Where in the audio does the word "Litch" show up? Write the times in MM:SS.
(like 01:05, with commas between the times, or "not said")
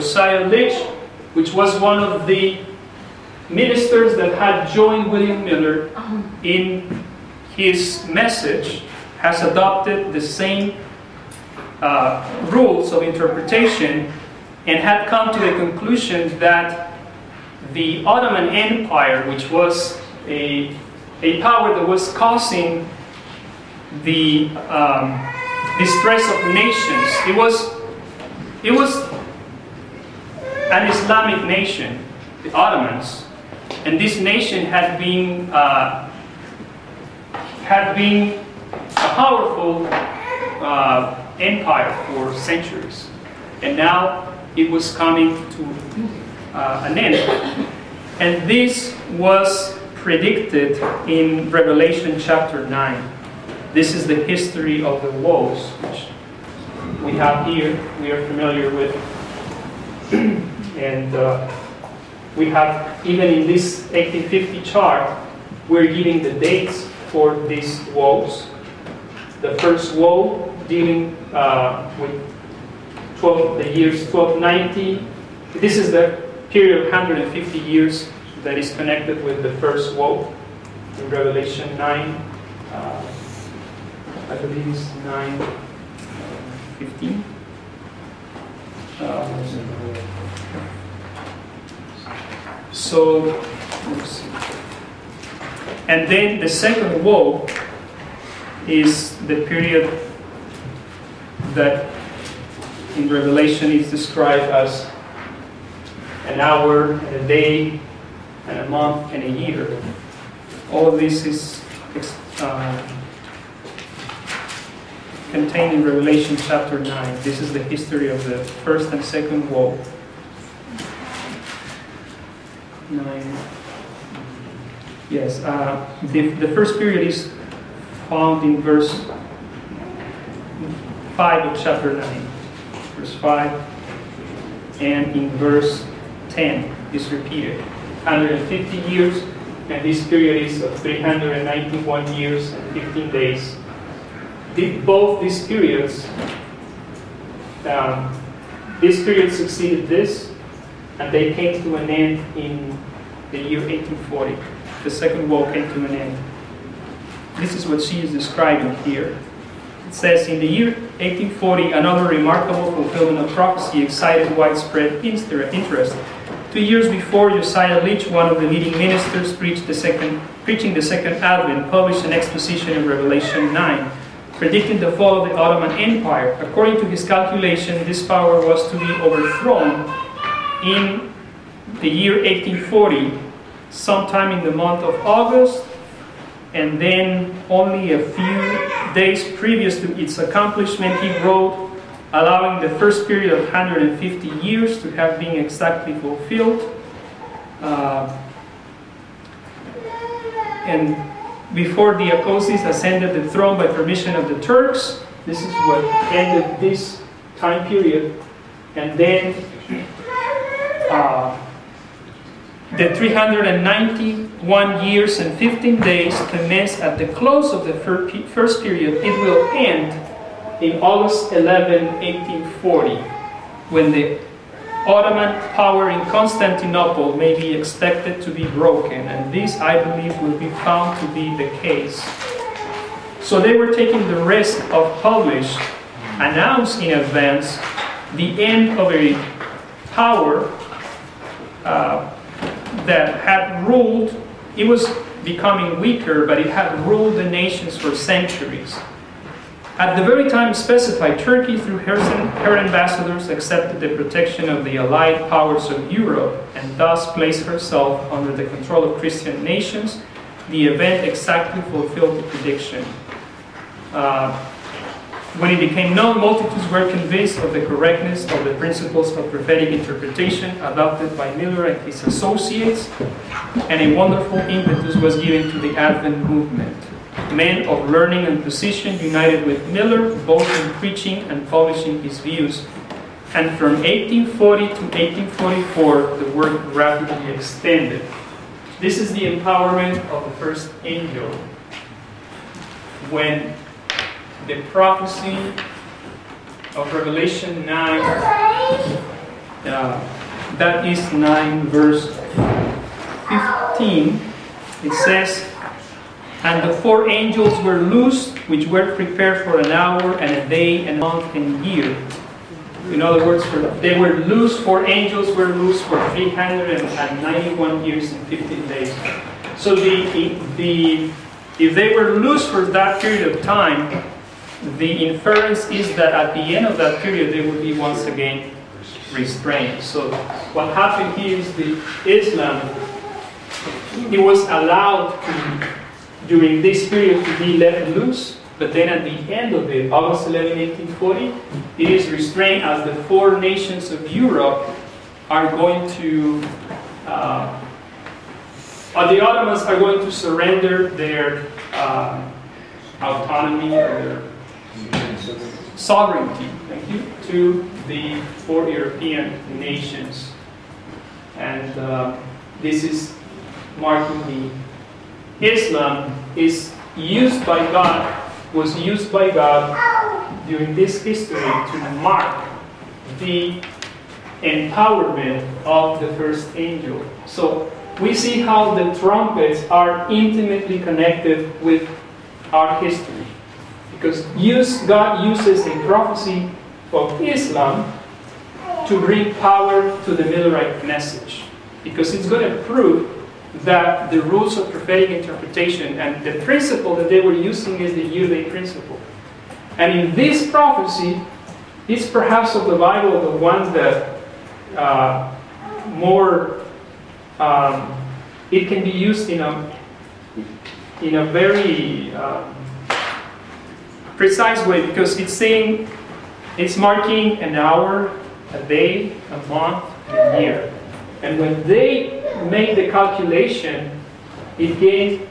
00:00, 02:47.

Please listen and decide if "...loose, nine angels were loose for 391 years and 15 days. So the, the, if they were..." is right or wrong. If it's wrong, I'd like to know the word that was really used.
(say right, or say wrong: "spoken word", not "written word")
wrong: "four", not "nine".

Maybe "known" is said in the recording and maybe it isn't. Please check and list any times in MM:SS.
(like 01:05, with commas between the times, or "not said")
04:25.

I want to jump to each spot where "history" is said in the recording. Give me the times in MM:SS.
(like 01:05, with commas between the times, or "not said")
00:54, 01:57, 06:11, 06:22.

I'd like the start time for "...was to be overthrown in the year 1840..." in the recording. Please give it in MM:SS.
02:58.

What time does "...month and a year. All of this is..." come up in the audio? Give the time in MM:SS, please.
01:48.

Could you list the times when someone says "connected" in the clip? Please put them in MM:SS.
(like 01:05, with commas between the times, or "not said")
01:18, 06:20.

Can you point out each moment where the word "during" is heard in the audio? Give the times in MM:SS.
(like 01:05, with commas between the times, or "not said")
05:36, 06:10.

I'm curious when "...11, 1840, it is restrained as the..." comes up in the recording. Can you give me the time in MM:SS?
05:40.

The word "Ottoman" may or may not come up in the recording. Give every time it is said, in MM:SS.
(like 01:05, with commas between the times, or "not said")
00:18, 00:32, 02:55, 03:44, 05:49.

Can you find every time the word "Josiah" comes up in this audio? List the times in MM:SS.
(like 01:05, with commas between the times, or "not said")
02:47.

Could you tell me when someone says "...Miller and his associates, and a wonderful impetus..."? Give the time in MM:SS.
04:31.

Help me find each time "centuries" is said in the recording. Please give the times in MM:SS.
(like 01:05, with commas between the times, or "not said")
00:42, 04:07.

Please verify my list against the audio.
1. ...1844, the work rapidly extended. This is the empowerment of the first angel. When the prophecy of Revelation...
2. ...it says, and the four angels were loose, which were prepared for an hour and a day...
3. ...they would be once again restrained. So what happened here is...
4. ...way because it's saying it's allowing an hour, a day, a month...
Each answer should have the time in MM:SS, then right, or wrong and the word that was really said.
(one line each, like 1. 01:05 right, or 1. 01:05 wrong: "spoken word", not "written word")
1. 04:44 right
2. 05:04 right
3. 05:27 right
4. 06:54 wrong: "marking", not "allowing".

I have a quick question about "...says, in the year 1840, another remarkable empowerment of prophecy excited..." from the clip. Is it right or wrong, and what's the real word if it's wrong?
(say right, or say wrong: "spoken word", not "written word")
wrong: "fulfillment", not "empowerment".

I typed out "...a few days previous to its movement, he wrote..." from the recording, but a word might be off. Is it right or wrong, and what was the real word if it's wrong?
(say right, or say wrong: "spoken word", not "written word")
wrong: "accomplishment", not "movement".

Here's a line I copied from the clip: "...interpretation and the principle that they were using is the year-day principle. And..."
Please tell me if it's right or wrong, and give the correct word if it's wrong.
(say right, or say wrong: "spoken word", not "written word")
right.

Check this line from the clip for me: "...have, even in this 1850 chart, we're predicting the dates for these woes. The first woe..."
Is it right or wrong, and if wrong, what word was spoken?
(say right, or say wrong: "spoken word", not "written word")
wrong: "giving", not "predicting".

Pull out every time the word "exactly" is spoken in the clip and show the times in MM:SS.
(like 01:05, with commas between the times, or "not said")
03:15, 04:21.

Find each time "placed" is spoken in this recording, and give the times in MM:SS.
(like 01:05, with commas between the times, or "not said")
04:17.